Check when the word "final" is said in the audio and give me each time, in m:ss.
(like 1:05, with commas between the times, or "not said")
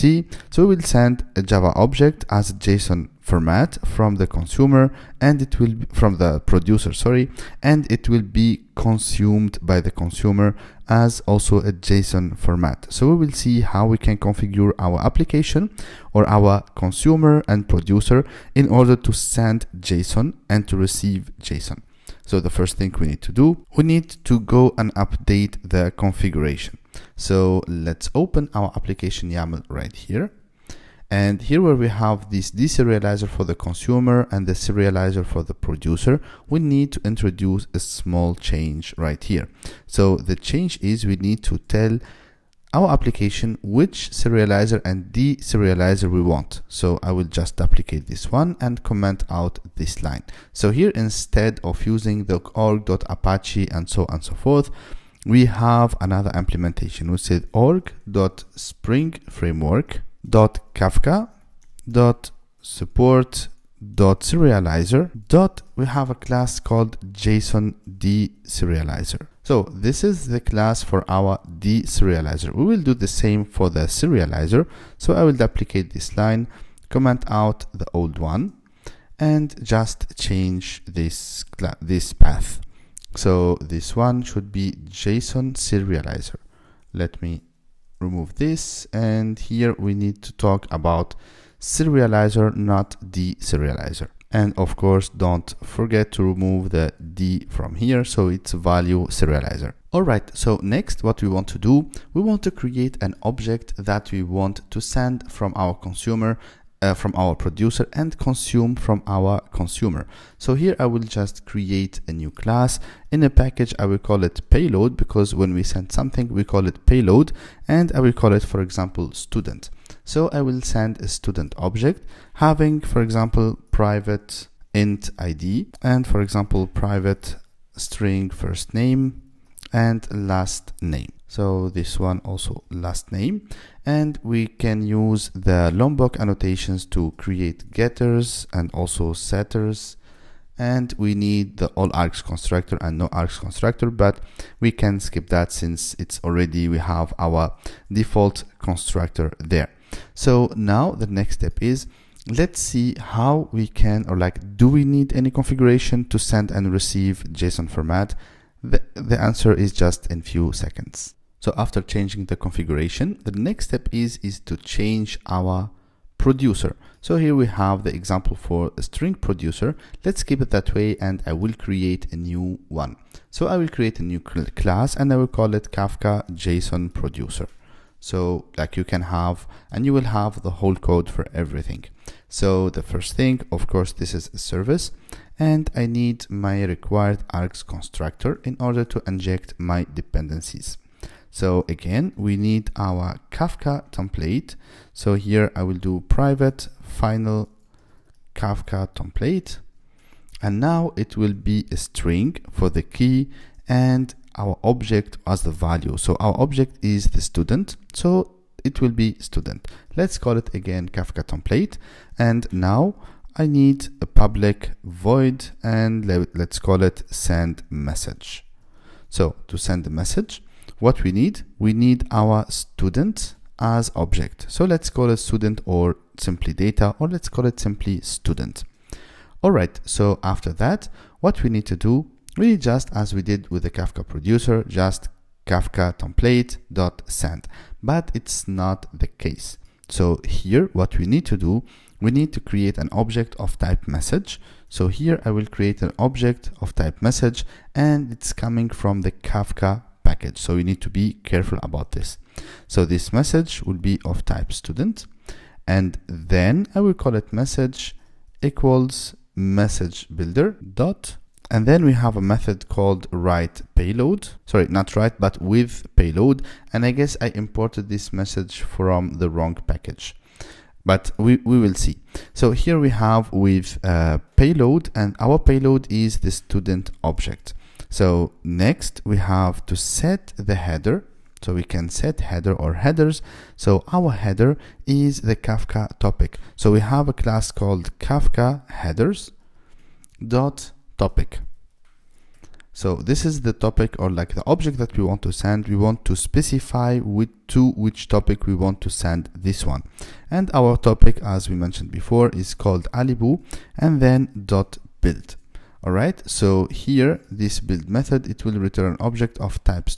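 3:16.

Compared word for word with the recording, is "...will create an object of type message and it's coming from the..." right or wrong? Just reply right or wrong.
right.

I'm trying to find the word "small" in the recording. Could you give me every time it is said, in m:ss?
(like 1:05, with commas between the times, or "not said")
0:37.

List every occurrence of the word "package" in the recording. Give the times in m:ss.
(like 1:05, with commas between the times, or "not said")
1:53, 4:10, 4:29.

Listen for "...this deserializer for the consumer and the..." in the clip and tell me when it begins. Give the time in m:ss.
0:32.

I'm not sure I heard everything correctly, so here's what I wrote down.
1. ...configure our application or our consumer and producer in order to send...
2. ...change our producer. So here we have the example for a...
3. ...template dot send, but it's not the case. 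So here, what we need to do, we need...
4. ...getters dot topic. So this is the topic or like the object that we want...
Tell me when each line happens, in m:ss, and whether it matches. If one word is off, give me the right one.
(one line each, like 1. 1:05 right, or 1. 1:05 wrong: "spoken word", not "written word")
1. 0:14 right
2. 2:44 right
3. 3:55 right
4. 4:48 wrong: "headers", not "getters".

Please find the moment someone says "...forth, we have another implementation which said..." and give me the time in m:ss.
0:54.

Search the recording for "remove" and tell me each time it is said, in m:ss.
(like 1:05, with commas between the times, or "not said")
1:27, 1:36.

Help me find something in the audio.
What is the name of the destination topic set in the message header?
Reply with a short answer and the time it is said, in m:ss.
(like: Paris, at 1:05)
Alibou, at 5:02.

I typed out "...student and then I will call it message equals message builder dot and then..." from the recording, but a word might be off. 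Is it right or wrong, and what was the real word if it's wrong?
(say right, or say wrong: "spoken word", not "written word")
right.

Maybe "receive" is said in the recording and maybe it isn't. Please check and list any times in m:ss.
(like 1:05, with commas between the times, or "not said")
0:20, 2:36.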